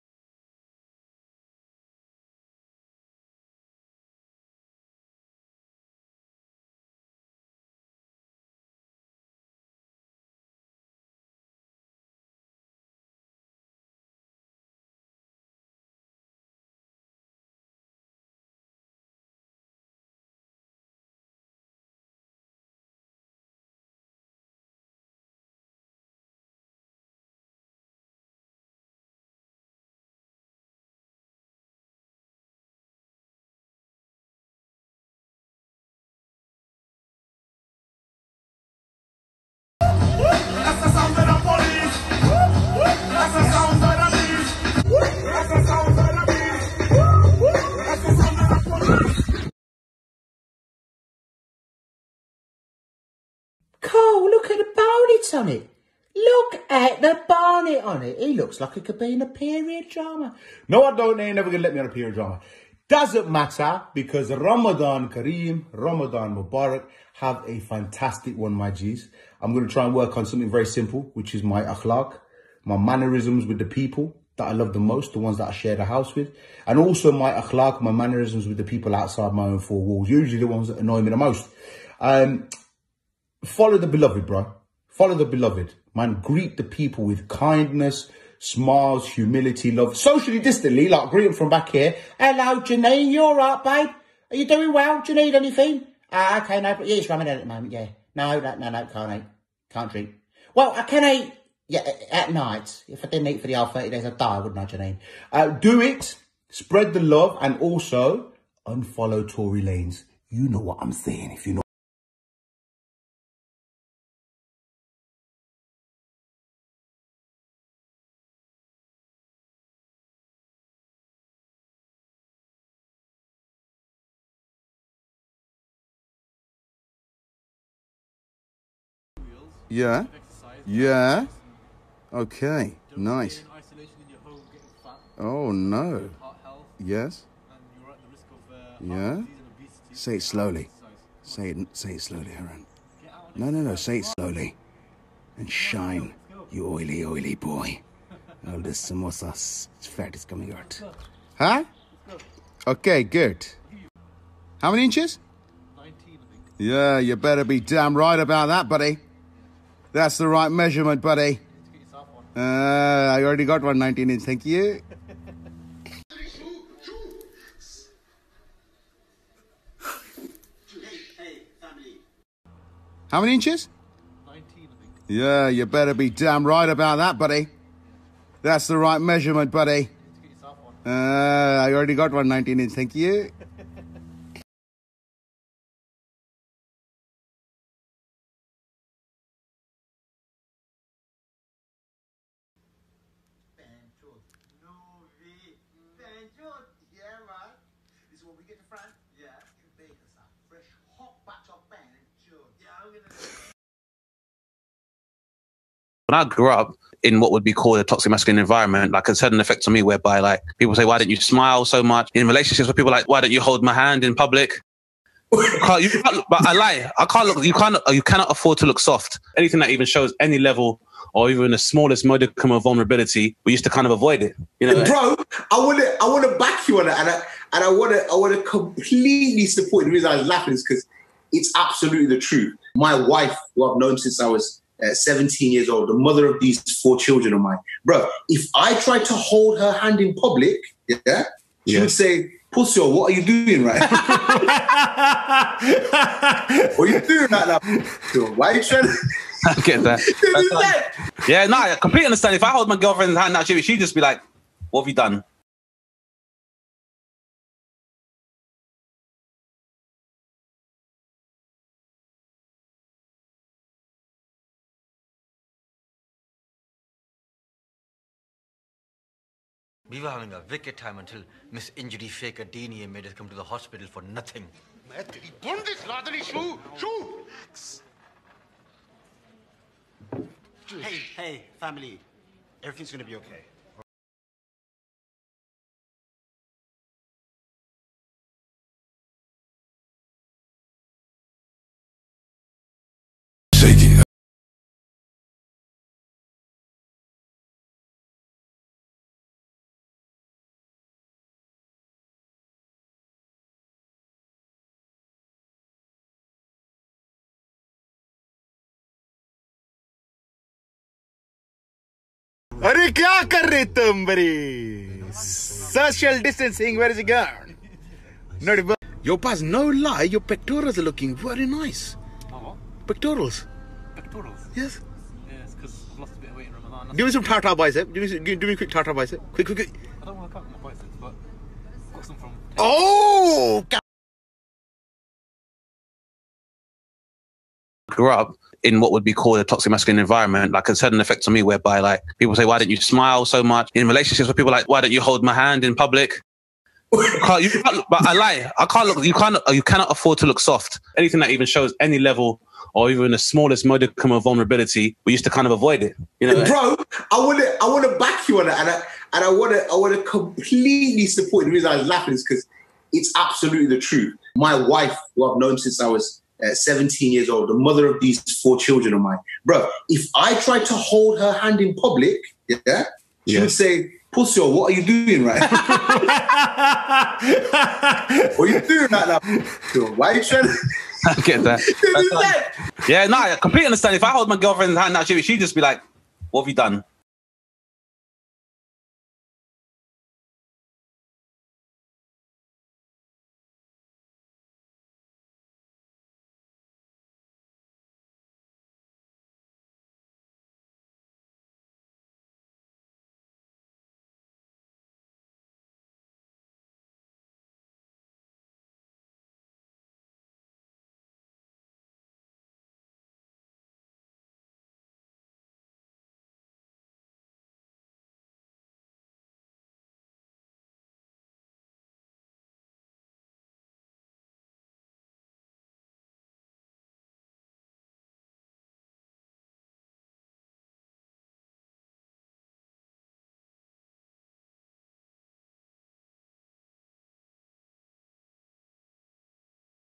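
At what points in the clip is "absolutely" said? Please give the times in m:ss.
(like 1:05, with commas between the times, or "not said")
3:51, 6:03.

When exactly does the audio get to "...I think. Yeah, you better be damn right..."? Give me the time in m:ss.
2:54.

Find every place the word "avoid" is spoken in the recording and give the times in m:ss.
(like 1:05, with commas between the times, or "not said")
3:43, 5:55.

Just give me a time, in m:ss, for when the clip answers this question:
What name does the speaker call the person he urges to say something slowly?
2:22.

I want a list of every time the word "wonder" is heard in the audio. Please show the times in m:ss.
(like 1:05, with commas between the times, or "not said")
not said.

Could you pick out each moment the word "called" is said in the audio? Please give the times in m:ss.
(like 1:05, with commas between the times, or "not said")
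3:27, 5:39.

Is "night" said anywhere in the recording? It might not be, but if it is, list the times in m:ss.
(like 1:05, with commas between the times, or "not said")
1:42.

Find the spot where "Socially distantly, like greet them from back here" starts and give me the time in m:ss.
1:29.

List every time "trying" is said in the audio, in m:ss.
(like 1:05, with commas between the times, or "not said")
4:08, 6:20.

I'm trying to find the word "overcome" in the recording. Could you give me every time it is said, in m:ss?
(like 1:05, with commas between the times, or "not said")
not said.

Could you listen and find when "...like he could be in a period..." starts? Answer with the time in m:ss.
0:58.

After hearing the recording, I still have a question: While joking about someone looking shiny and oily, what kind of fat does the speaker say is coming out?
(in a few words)
Samosa fat.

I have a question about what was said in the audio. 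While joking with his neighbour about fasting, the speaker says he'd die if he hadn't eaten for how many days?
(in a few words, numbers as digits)
30.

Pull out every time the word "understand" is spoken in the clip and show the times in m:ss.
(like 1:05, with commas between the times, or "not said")
4:12, 6:23.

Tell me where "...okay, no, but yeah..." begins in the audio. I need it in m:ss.
1:36.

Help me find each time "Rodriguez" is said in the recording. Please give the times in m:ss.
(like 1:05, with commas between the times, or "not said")
not said.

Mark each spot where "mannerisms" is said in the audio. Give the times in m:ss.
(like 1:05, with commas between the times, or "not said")
1:12, 1:17.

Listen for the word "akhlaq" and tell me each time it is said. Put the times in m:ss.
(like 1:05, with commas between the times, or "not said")
1:11, 1:17.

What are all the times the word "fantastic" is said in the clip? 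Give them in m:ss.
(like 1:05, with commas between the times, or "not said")
1:07.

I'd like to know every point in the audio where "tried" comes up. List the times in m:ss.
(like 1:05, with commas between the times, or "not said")
3:58, 6:10.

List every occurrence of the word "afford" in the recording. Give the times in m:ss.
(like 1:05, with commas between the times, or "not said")
3:38, 5:49.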